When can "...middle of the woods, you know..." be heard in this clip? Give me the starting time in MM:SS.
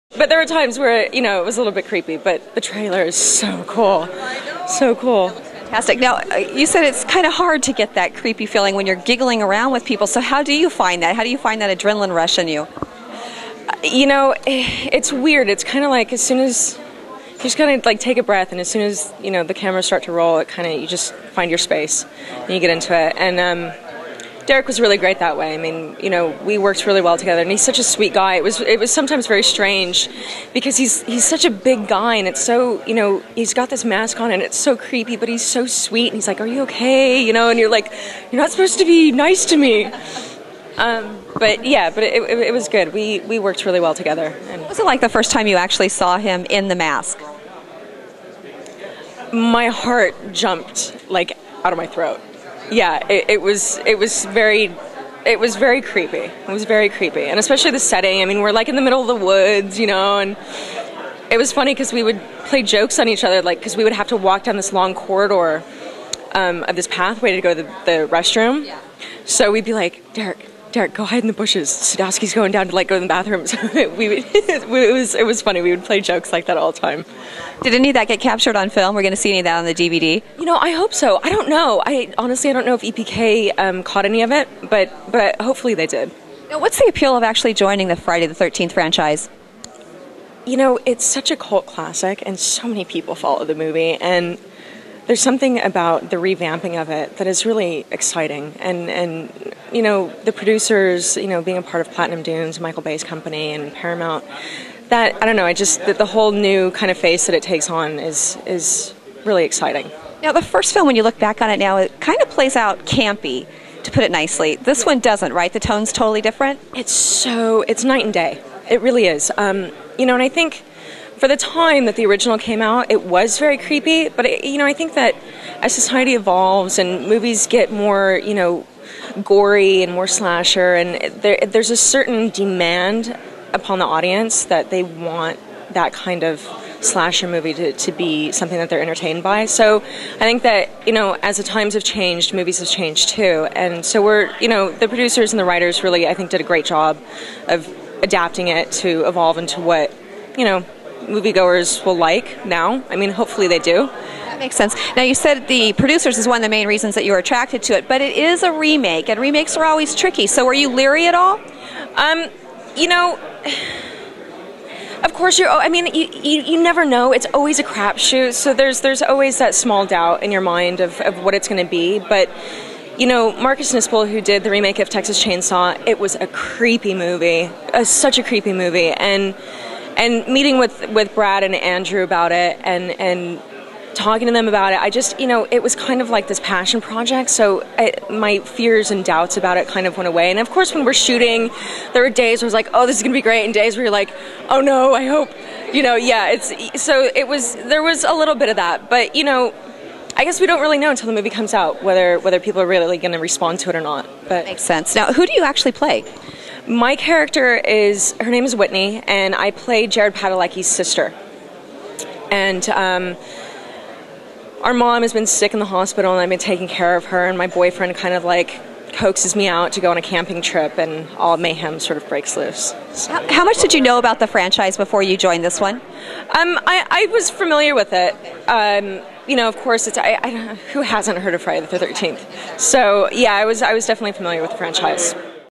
00:58.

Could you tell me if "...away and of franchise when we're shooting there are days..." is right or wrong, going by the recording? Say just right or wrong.
wrong.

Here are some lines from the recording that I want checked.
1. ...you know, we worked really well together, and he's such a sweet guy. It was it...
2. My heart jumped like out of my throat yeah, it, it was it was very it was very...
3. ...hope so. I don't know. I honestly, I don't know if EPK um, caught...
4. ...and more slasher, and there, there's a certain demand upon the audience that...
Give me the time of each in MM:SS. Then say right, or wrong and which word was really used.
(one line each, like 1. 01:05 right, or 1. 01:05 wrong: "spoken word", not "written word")
1. 00:26 right
2. 00:49 right
3. 01:20 right
4. 02:09 right.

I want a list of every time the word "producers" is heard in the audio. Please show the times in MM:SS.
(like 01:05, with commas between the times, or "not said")
01:40, 02:24, 02:35.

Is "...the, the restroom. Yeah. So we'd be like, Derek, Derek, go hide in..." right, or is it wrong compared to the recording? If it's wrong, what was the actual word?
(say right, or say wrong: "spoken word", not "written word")
right.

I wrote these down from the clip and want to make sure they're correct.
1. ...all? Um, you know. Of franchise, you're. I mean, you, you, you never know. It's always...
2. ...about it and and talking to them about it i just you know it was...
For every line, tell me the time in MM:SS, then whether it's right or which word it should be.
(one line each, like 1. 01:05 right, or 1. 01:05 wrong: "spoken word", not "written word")
1. 02:41 wrong: "course", not "franchise"
2. 03:02 right.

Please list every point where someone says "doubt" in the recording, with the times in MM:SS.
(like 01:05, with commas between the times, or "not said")
02:49, 03:09.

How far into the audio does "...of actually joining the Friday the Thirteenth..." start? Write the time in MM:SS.
01:27.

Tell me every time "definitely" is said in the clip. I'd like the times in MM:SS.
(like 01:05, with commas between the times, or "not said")
03:53.